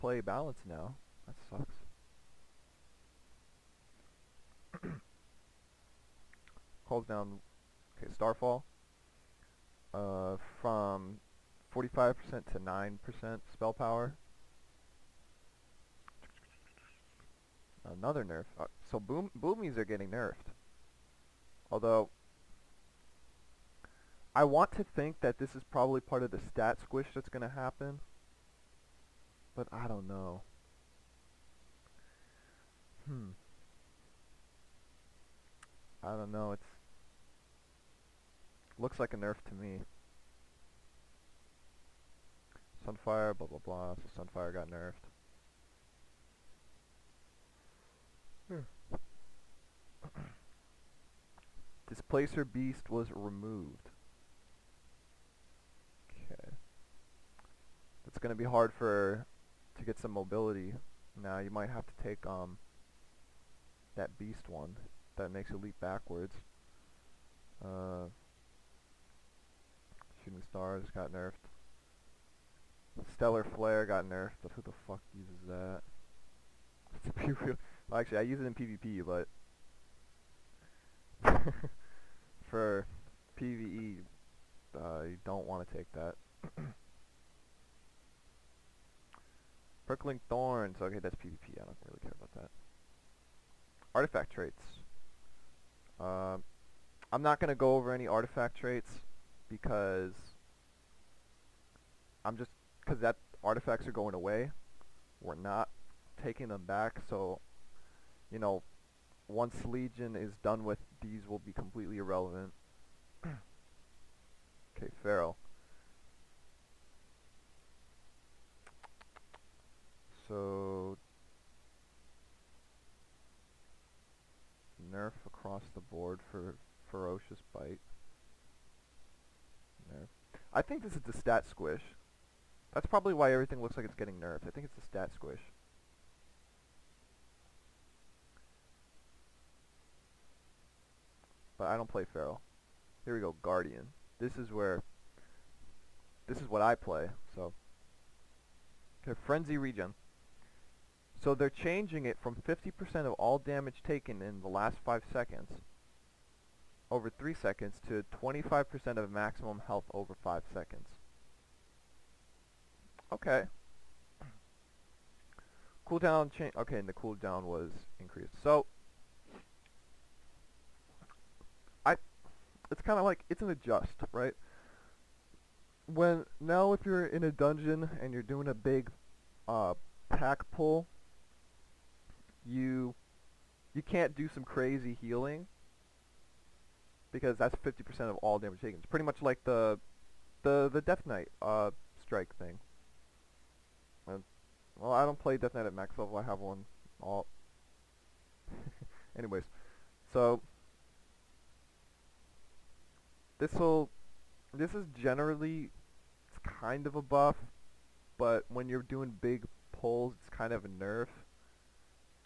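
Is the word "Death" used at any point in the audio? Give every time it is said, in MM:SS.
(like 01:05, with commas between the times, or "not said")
03:10, 03:15.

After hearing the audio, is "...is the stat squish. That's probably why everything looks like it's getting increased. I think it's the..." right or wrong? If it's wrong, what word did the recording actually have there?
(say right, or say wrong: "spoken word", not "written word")
wrong: "nerfed", not "increased".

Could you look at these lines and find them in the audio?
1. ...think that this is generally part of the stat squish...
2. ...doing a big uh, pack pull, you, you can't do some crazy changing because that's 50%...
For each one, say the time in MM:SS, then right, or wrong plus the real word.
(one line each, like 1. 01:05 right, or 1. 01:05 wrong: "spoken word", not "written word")
1. 00:24 wrong: "probably", not "generally"
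2. 02:58 wrong: "healing", not "changing".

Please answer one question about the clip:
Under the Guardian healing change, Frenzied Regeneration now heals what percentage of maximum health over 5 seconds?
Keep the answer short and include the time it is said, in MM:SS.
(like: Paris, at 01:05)
25%, at 02:38.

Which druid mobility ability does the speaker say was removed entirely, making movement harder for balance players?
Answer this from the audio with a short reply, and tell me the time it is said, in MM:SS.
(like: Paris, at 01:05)
Displacer Beast, at 00:51.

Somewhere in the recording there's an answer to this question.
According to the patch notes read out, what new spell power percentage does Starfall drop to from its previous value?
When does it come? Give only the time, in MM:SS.
00:12.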